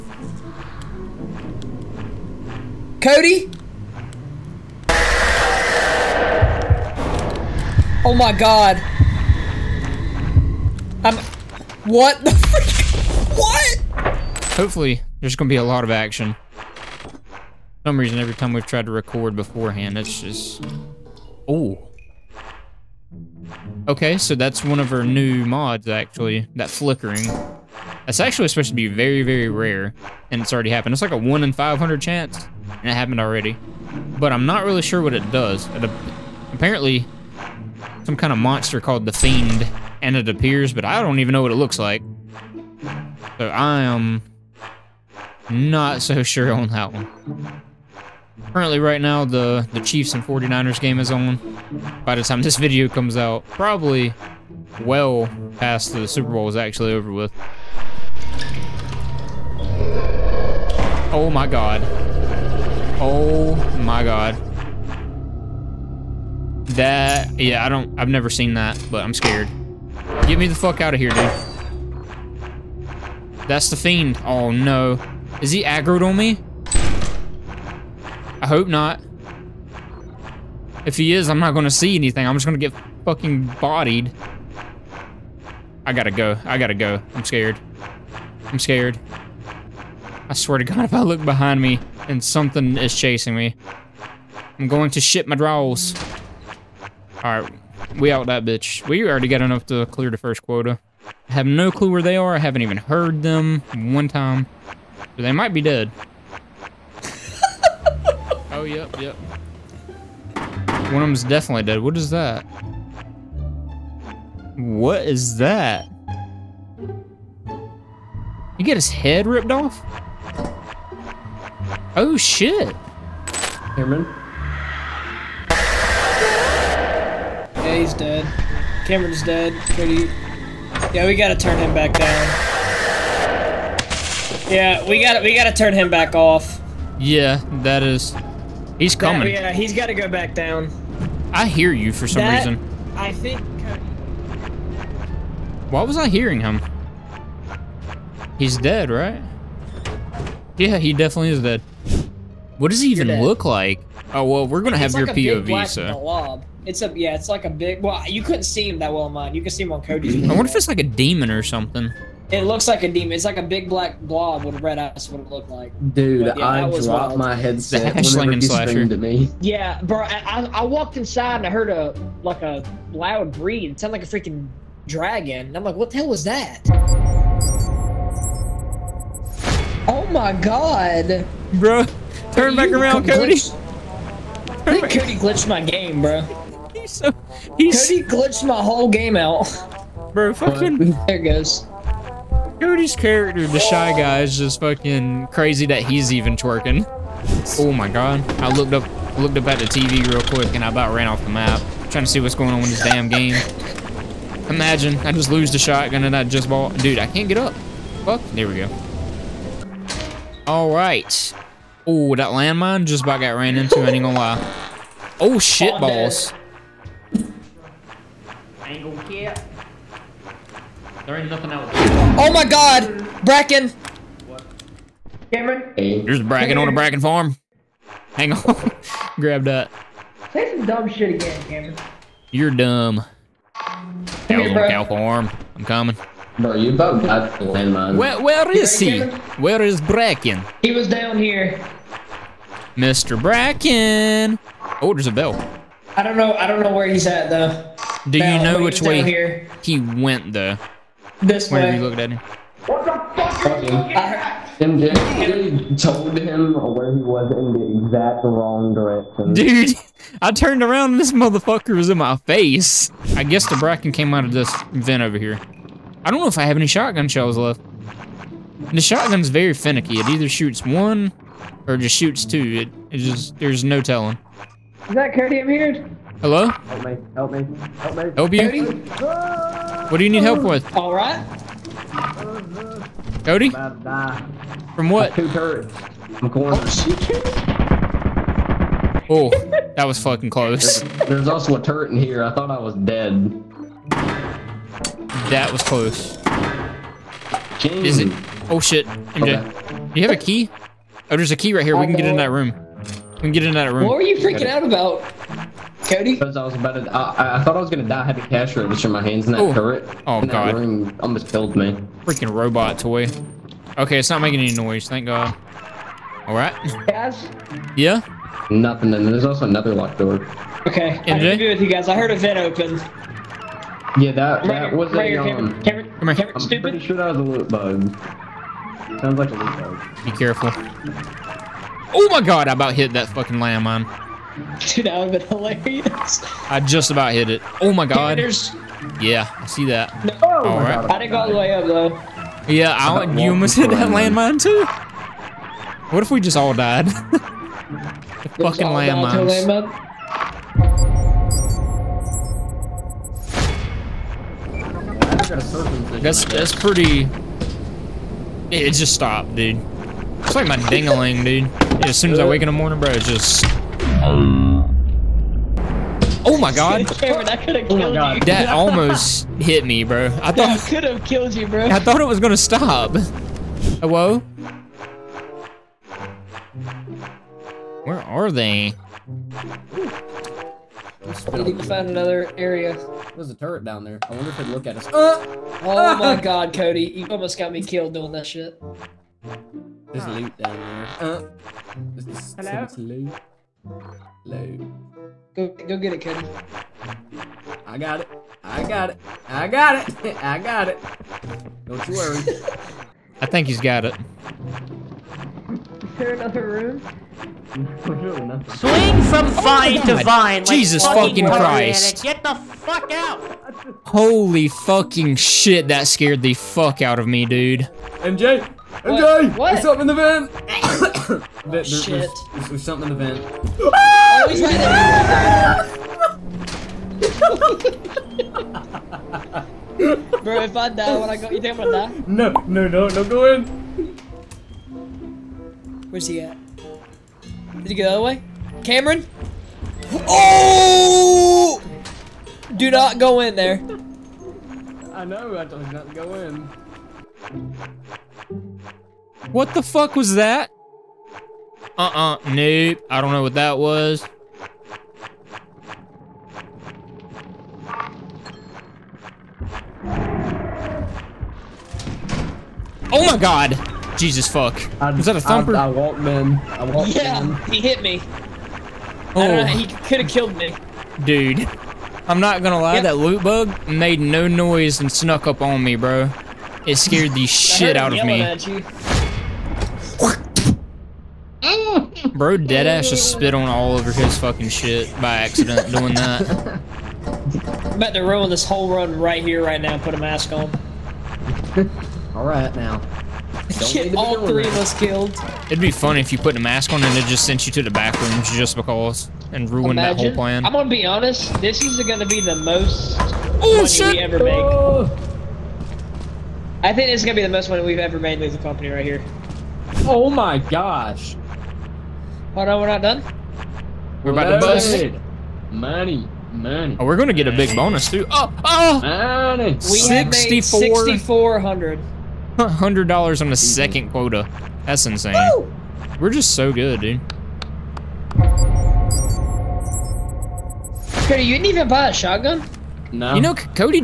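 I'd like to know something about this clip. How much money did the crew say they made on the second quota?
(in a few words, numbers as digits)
$6,400.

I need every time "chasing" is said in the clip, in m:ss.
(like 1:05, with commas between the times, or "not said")
1:32.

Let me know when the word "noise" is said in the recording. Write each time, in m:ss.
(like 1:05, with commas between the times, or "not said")
5:14, 7:54.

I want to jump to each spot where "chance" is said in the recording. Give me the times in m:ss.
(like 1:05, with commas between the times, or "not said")
0:32.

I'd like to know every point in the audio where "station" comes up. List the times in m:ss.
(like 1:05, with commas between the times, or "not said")
not said.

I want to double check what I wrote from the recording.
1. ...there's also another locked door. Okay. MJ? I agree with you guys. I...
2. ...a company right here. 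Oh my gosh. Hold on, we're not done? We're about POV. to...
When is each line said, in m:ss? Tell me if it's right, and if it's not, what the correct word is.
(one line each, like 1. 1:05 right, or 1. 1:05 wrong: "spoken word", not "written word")
1. 5:19 right
2. 8:28 wrong: "Loaded", not "POV".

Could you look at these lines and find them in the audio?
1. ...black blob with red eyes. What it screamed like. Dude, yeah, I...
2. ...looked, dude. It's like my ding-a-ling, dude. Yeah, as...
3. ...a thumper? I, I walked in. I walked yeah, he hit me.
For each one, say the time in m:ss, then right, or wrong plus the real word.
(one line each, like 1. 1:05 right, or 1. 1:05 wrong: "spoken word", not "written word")
1. 2:43 wrong: "looked", not "screamed"
2. 5:58 wrong: "stopped", not "looked"
3. 7:45 right.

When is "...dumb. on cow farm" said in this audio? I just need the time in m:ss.
3:52.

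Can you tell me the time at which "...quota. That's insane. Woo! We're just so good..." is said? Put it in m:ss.
8:43.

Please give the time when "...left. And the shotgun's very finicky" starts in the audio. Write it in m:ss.
4:27.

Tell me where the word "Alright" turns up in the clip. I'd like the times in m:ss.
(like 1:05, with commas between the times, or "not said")
1:37, 3:30, 8:12.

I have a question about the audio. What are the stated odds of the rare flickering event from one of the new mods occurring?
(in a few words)
1 in 500.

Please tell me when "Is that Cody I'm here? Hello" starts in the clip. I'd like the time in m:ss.
4:34.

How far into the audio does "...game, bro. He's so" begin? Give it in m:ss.
3:05.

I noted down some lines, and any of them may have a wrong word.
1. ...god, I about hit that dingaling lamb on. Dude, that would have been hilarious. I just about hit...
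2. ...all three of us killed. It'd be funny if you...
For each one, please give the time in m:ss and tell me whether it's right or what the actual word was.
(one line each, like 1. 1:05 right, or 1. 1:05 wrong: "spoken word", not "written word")
1. 5:32 wrong: "fucking", not "dingaling"
2. 8:13 right.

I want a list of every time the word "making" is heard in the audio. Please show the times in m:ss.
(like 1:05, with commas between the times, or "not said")
5:14.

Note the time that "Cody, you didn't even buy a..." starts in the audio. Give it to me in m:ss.
8:51.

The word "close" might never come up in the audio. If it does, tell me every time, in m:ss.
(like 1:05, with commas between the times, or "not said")
4:50, 4:55.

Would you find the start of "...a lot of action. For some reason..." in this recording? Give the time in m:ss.
0:15.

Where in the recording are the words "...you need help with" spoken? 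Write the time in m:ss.
4:40.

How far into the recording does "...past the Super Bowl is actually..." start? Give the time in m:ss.
0:55.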